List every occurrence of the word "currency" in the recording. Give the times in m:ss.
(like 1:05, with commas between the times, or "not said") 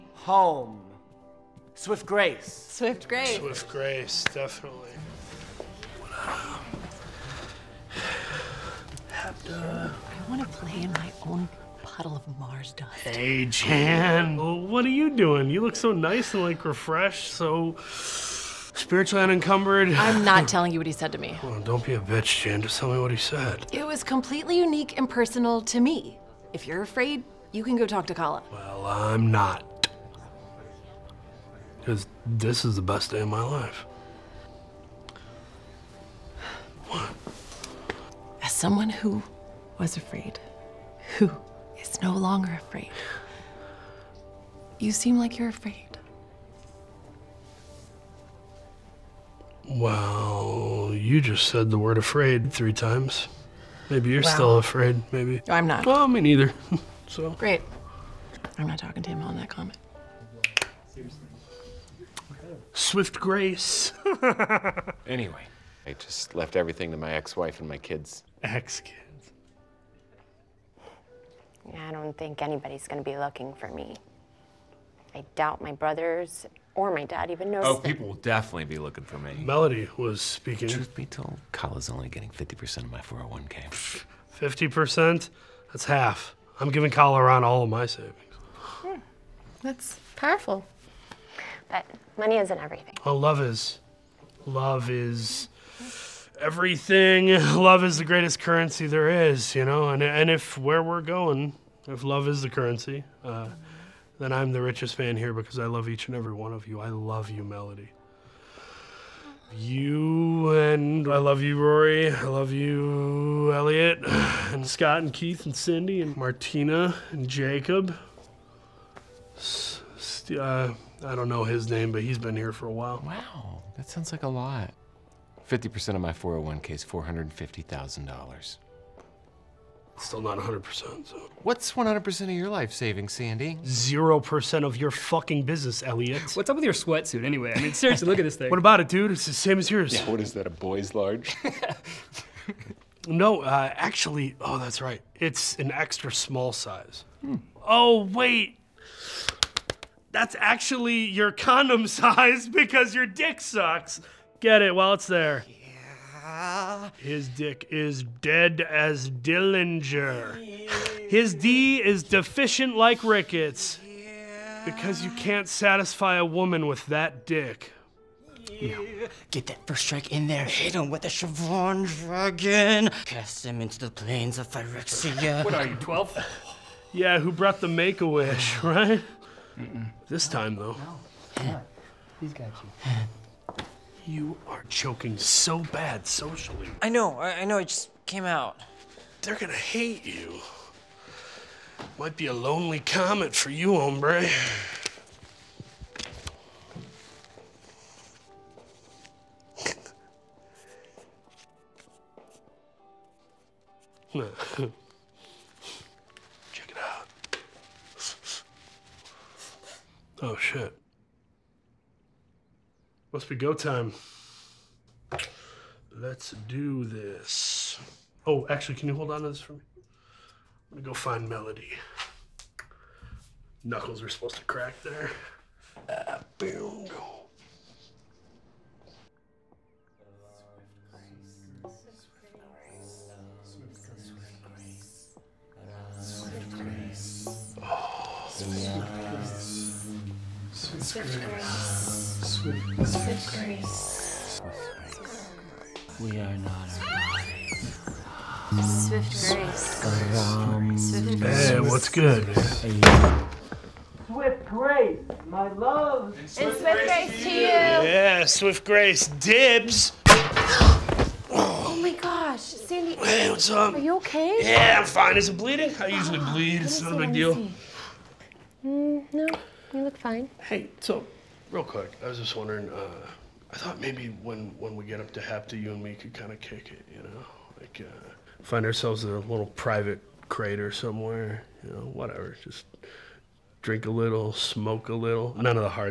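1:38, 1:42.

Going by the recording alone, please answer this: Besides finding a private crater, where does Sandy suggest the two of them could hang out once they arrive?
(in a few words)
Hepta.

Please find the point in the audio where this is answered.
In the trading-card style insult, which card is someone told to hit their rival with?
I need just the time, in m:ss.
2:51.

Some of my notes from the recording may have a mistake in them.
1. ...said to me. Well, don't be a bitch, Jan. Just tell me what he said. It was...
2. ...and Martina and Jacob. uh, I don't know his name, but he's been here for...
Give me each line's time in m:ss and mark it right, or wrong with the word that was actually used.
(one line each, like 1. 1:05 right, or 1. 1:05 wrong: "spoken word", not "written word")
1. 0:20 right
2. 1:56 right.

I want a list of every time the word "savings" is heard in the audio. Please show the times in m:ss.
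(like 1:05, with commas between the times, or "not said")
1:27, 2:12.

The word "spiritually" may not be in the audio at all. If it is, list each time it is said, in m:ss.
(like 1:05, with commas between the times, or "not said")
0:17.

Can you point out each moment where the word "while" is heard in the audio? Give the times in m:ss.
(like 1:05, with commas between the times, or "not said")
2:02, 2:34.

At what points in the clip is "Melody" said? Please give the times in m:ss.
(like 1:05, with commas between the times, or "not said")
1:19, 1:47, 3:41.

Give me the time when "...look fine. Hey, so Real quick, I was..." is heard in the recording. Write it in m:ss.
4:29.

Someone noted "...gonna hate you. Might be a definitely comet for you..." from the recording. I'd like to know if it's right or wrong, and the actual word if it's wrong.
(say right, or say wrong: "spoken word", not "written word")
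wrong: "lonely", not "definitely".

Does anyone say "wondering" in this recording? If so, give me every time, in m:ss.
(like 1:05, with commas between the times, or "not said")
4:32.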